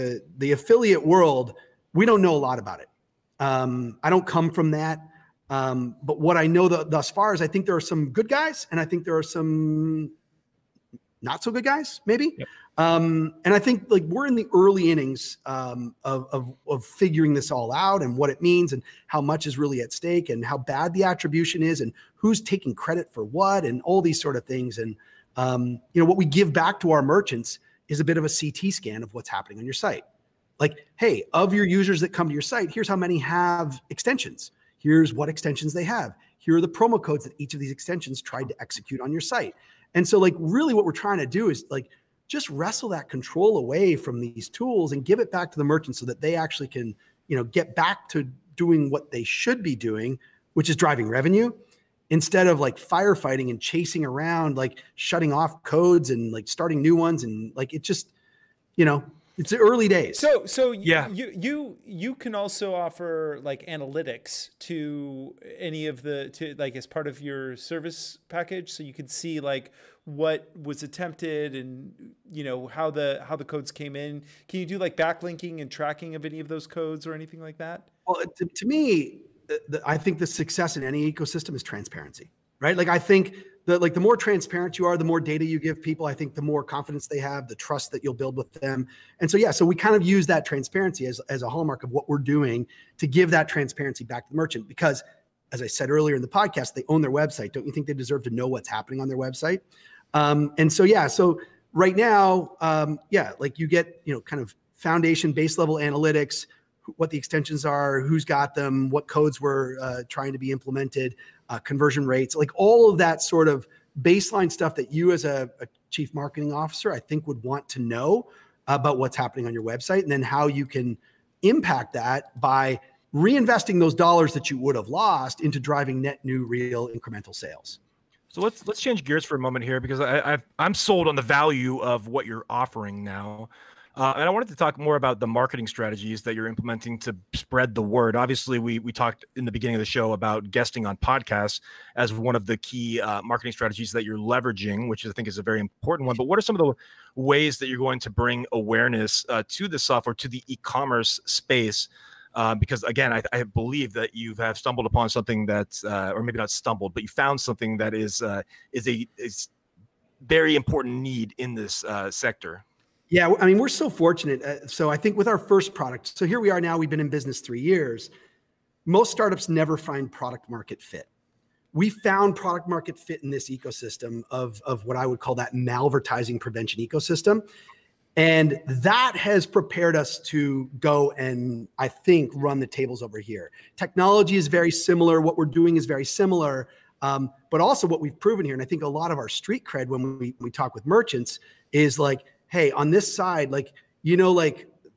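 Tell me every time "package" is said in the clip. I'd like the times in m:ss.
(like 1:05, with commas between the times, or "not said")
1:08.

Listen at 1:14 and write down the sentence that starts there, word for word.
Can you do like backlinking and tracking of any of those codes or anything like that?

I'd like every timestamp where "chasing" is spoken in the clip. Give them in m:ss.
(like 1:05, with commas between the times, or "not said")
0:53.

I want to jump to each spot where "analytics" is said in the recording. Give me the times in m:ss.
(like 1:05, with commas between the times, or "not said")
1:03, 1:45.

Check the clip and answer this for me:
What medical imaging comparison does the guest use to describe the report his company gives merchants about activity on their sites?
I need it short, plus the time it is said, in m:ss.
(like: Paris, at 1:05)
CT scan, at 0:28.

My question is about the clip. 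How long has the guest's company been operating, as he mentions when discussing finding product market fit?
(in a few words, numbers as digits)
3 years.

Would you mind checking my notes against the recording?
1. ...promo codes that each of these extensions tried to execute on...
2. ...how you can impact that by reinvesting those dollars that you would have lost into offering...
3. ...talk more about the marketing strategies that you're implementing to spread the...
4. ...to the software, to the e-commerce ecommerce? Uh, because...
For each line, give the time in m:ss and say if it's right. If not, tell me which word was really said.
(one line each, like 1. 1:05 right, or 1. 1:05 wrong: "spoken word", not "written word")
1. 0:36 right
2. 2:00 wrong: "driving", not "offering"
3. 2:14 right
4. 2:29 wrong: "space", not "ecommerce".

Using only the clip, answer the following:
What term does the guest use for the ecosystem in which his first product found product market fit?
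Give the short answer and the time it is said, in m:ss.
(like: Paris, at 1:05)
Malvertising prevention, at 2:55.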